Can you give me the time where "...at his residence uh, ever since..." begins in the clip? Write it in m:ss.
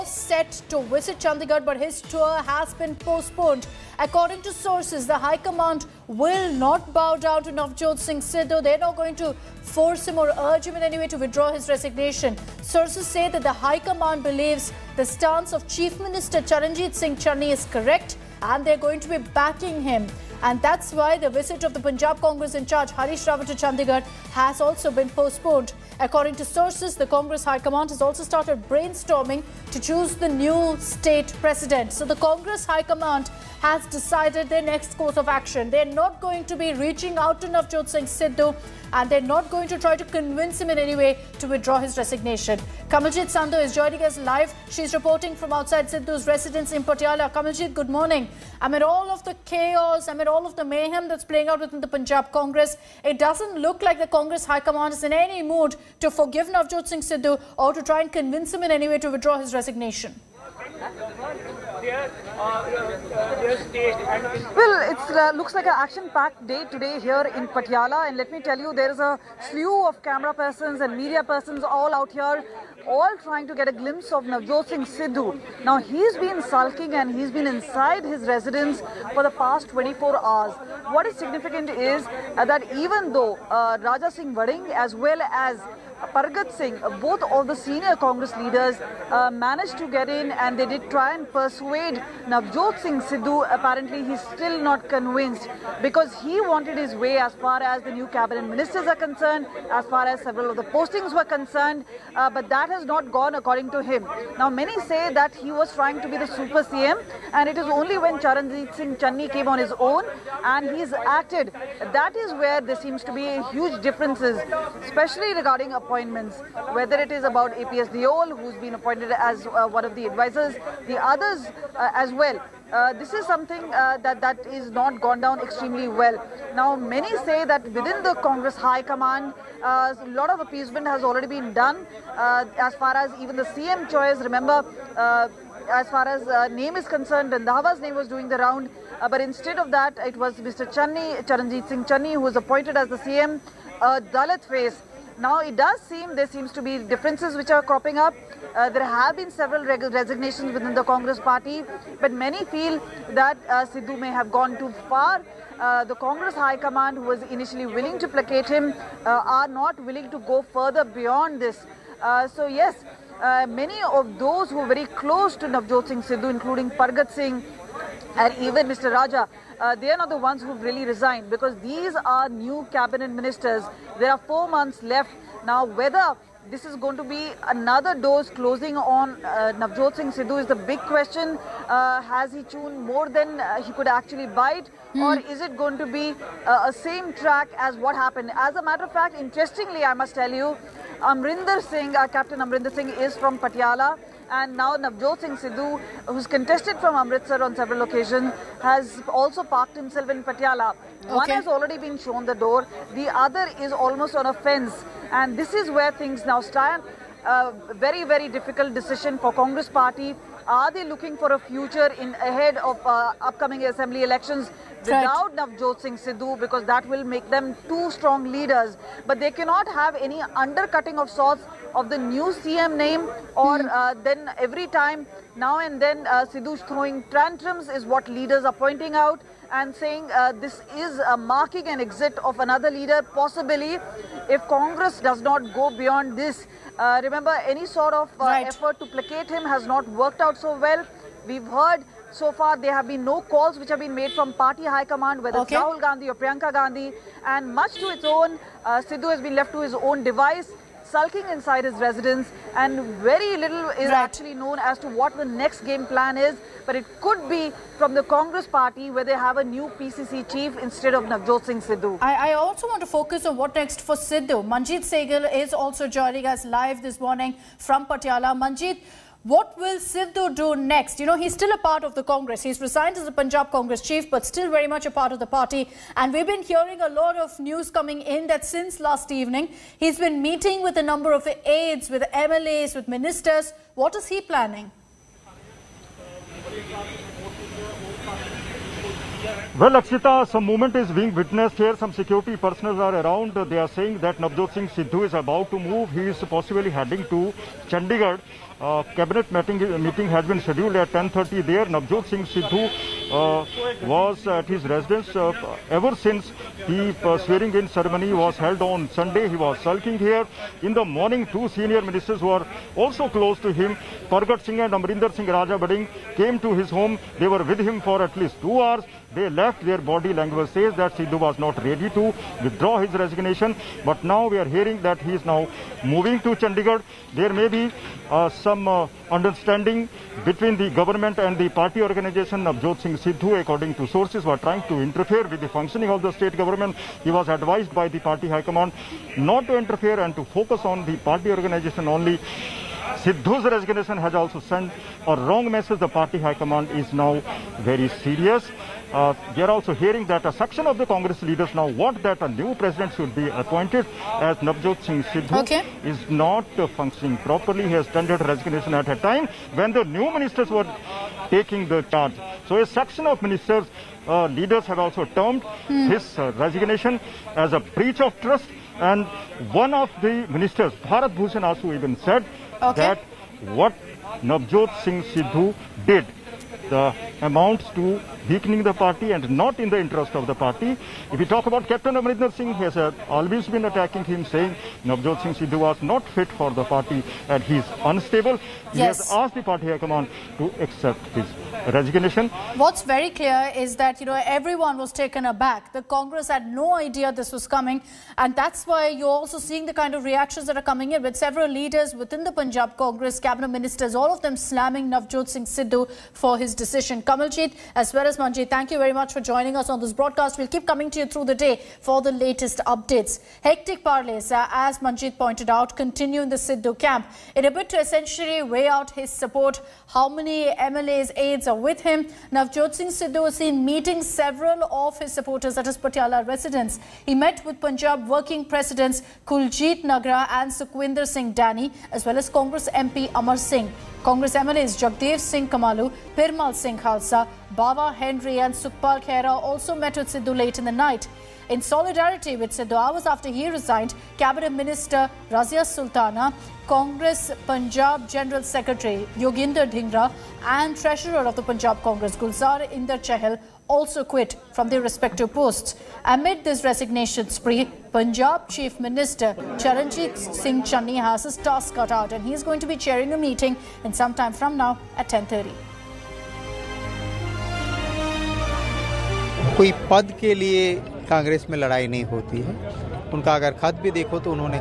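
5:04.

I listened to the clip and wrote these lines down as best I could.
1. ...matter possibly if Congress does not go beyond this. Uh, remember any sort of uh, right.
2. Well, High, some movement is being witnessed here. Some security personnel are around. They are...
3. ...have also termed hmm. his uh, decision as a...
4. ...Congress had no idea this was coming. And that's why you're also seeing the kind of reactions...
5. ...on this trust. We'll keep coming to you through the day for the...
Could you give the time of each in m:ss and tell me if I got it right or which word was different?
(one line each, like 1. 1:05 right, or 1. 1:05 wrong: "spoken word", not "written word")
1. 3:52 wrong: "leader", not "matter"
2. 4:49 wrong: "Akshita", not "High"
3. 6:04 wrong: "resignation", not "decision"
4. 6:35 right
5. 6:49 wrong: "broadcast", not "trust".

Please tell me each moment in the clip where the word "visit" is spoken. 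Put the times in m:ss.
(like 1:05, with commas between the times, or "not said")
0:00, 0:21.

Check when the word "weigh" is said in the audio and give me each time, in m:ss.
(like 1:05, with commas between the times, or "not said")
6:58.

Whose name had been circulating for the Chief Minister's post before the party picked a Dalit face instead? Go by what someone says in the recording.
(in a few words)
Randhawa.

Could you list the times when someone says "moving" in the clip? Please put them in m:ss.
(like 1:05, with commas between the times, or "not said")
5:25.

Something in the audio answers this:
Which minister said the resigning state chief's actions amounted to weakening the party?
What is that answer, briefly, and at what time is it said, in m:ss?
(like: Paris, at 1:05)
Bharat Bhushan Asu, at 6:10.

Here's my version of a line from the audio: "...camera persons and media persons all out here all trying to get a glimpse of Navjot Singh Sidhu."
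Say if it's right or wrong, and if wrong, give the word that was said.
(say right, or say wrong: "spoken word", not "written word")
right.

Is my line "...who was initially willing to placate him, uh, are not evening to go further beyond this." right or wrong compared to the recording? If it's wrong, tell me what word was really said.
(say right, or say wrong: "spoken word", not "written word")
wrong: "willing", not "evening".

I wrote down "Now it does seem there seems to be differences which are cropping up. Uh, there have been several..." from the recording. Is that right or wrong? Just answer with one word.
right.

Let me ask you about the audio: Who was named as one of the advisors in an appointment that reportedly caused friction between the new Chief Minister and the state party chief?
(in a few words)
APS Deol.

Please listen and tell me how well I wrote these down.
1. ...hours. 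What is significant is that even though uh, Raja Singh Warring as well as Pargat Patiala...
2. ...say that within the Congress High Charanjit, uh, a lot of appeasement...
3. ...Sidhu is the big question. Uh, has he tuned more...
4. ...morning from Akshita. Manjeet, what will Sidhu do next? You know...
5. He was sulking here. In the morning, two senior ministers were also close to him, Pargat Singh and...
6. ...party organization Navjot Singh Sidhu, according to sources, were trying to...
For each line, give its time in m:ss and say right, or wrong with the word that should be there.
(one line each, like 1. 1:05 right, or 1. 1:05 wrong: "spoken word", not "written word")
1. 1:20 wrong: "Singh", not "Patiala"
2. 2:07 wrong: "Command", not "Charanjit"
3. 3:00 right
4. 4:26 wrong: "Patiala", not "Akshita"
5. 5:09 right
6. 5:31 right.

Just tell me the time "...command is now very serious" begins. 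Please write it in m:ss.
5:46.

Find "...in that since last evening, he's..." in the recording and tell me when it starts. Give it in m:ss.
4:38.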